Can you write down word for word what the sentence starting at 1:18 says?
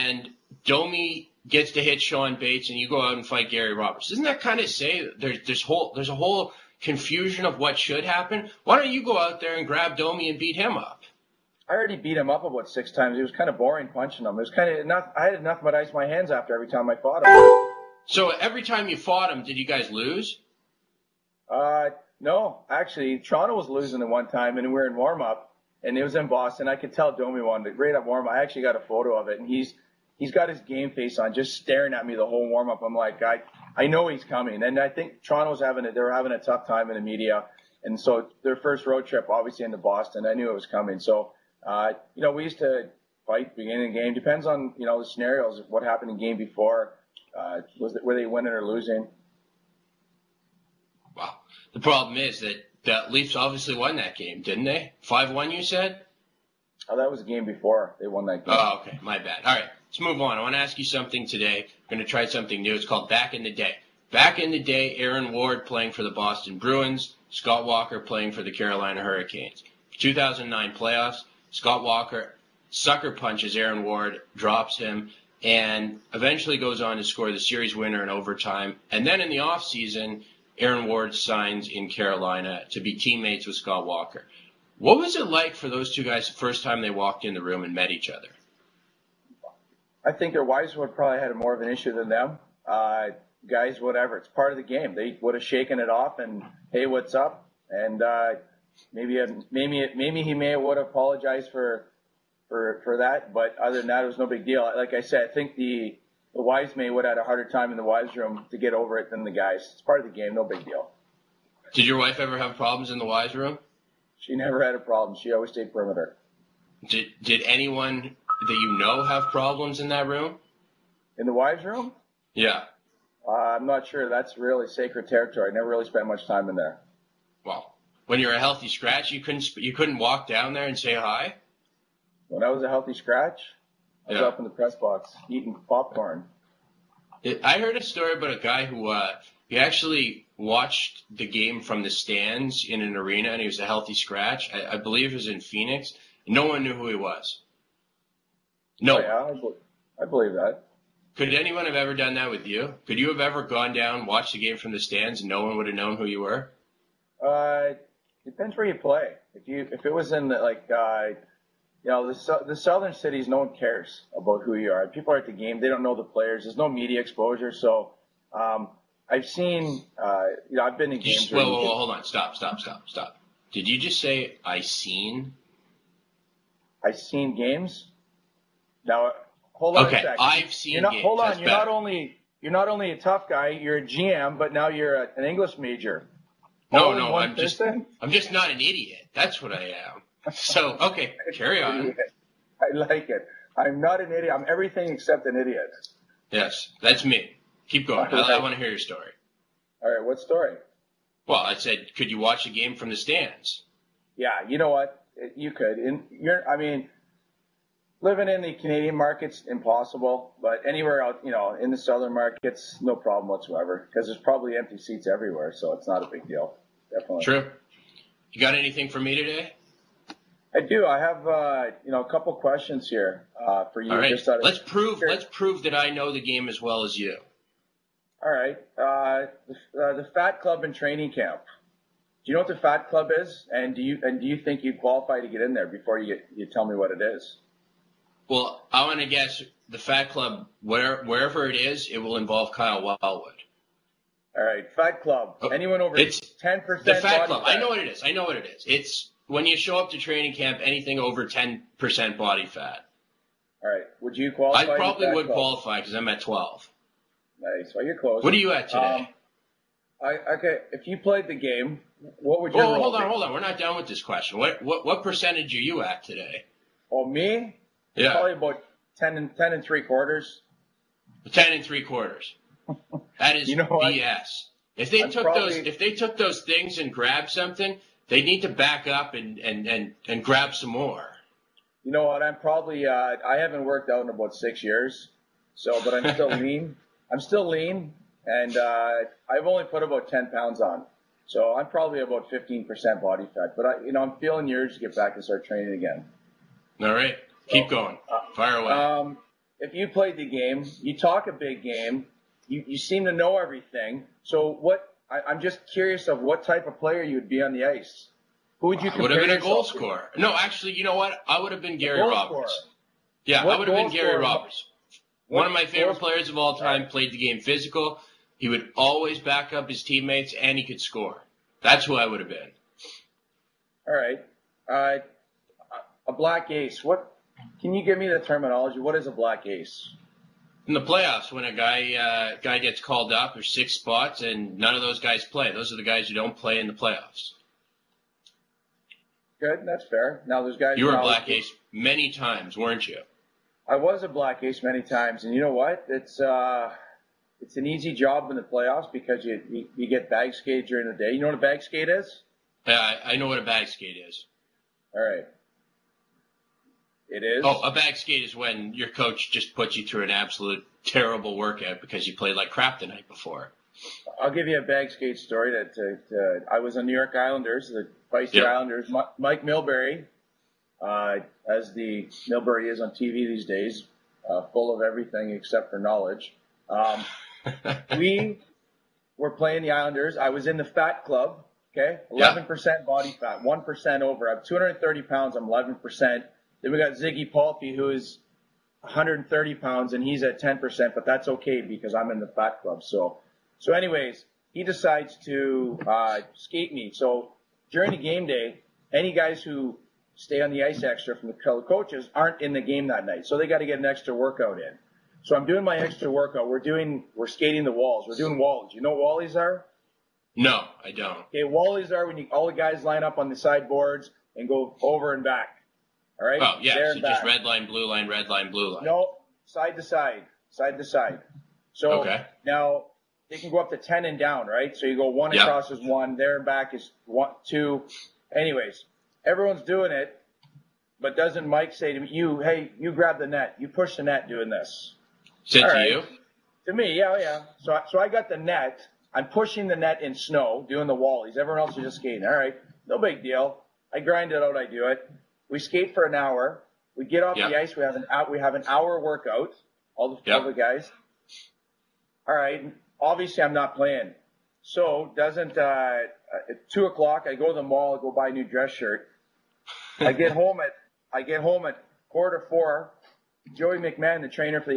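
And then in the offseason, Aaron Ward signs in Carolina to be teammates with Scott Walker.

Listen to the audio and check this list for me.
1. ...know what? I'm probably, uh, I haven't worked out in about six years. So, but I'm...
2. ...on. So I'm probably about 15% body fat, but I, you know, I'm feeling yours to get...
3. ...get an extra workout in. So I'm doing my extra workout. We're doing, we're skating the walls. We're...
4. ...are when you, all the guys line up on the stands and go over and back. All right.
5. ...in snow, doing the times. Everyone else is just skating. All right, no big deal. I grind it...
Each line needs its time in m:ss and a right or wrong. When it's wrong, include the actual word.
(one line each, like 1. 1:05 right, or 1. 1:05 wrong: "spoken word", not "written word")
1. 4:41 right
2. 4:50 right
3. 6:43 right
4. 6:51 wrong: "sideboards", not "stands"
5. 7:20 wrong: "wallies", not "times".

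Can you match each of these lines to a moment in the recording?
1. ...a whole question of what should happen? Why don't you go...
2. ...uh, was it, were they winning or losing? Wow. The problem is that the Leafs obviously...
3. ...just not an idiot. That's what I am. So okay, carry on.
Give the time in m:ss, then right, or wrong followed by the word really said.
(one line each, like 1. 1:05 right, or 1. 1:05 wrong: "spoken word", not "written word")
1. 0:06 wrong: "confusion", not "question"
2. 0:47 right
3. 3:08 right.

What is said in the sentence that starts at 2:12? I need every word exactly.
When I was a healthy scratch, I was up in the press box eating popcorn.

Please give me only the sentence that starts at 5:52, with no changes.
Yeah, I, I know what a bag skate is.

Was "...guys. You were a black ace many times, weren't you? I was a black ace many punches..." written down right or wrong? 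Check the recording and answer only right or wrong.
wrong.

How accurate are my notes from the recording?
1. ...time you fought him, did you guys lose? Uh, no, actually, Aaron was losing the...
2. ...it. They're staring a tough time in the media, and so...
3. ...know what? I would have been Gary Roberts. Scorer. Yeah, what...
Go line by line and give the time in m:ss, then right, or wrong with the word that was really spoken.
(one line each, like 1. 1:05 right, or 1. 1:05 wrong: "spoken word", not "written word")
1. 0:18 wrong: "Toronto", not "Aaron"
2. 0:35 wrong: "having", not "staring"
3. 5:10 right.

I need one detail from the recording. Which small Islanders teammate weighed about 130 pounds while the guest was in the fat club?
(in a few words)
Ziggy Palffy.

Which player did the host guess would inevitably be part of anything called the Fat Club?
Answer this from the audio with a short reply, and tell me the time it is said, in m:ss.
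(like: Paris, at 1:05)
Kyle Wellwood, at 4:02.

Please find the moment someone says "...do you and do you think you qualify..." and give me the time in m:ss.
3:53.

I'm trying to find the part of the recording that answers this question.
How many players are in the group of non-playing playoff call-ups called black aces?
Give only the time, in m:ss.
5:33.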